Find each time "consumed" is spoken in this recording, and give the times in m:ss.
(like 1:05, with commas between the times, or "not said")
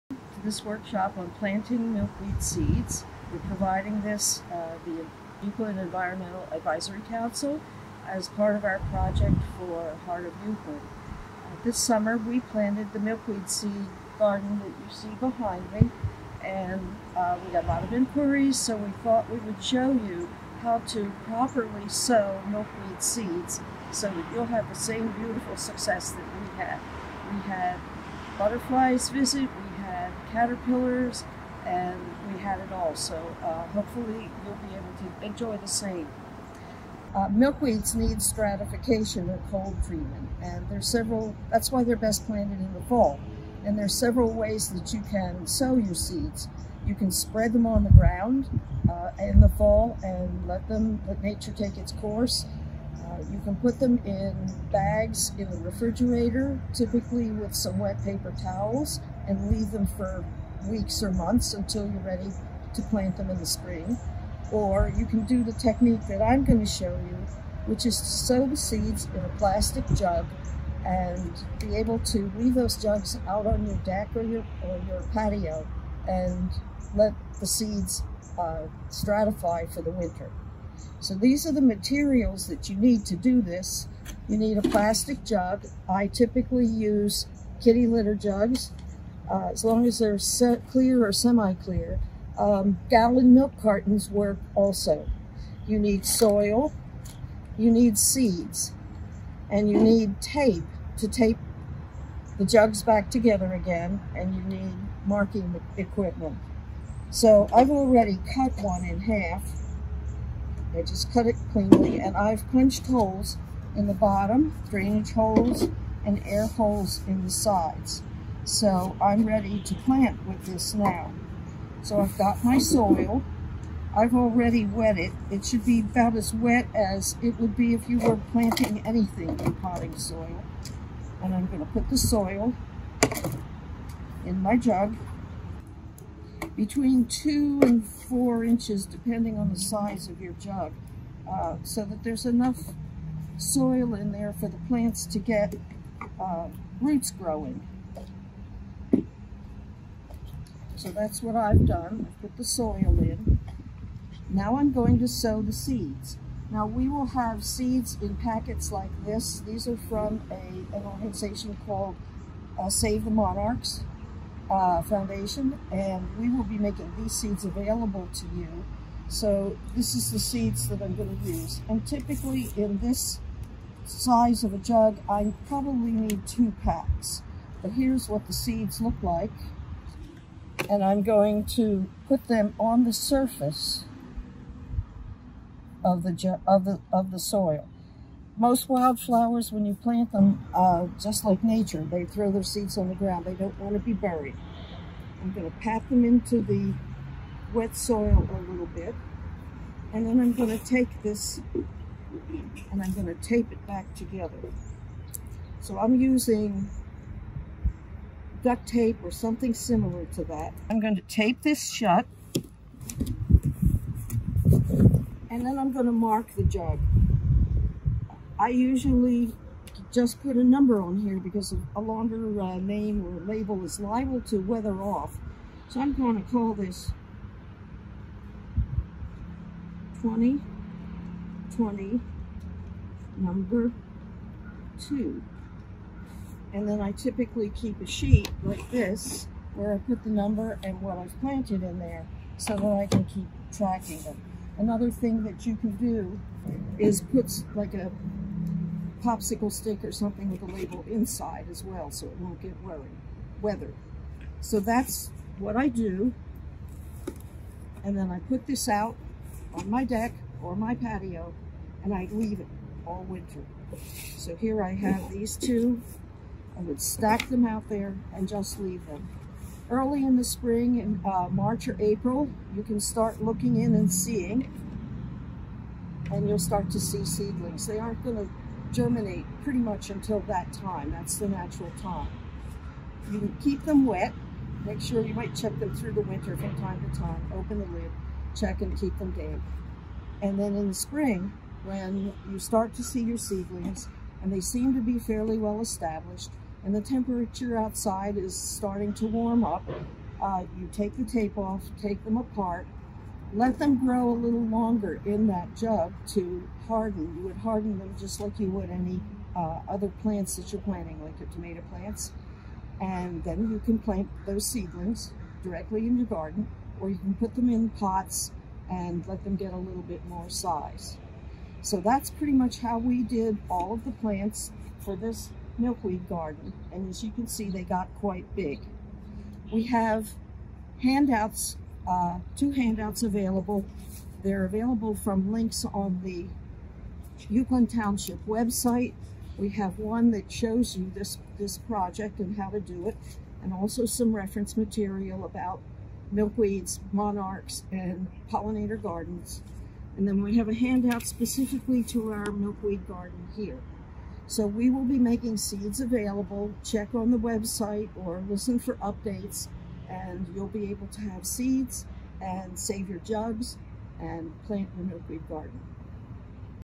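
not said.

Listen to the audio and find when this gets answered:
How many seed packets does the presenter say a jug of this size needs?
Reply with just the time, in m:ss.
2:56.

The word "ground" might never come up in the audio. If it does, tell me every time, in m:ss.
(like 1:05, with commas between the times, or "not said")
0:47, 3:12.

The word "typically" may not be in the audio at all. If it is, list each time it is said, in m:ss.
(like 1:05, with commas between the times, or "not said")
0:56, 1:26, 2:51, 3:56.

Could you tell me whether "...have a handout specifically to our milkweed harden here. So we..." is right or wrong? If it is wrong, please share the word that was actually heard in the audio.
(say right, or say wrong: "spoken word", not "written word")
wrong: "garden", not "harden".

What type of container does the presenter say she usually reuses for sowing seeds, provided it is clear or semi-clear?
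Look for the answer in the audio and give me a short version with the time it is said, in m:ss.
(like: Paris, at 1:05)
Kitty litter jugs, at 1:27.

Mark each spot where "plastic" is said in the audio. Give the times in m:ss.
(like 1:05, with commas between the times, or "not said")
1:09, 1:24.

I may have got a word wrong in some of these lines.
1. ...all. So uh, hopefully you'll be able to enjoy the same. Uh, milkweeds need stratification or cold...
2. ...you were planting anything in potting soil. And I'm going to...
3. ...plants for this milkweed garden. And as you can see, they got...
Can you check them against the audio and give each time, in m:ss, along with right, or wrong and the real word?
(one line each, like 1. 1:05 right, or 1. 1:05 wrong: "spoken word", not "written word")
1. 0:32 right
2. 2:07 right
3. 5:23 right.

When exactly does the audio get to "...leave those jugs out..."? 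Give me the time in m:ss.
1:12.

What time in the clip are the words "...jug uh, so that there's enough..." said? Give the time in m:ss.
2:20.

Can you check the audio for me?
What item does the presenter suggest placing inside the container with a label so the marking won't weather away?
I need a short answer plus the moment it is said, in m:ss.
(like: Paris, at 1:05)
Popsicle stick, at 4:09.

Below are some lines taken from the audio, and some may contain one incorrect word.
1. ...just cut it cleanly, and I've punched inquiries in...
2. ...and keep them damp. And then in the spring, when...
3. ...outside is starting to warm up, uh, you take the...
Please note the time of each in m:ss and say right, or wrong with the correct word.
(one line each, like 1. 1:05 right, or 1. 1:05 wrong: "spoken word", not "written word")
1. 1:50 wrong: "holes", not "inquiries"
2. 4:48 right
3. 4:57 right.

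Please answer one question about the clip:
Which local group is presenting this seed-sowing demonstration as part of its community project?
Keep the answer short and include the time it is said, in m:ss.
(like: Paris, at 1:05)
Uwchlan Environmental Advisory Council, at 0:05.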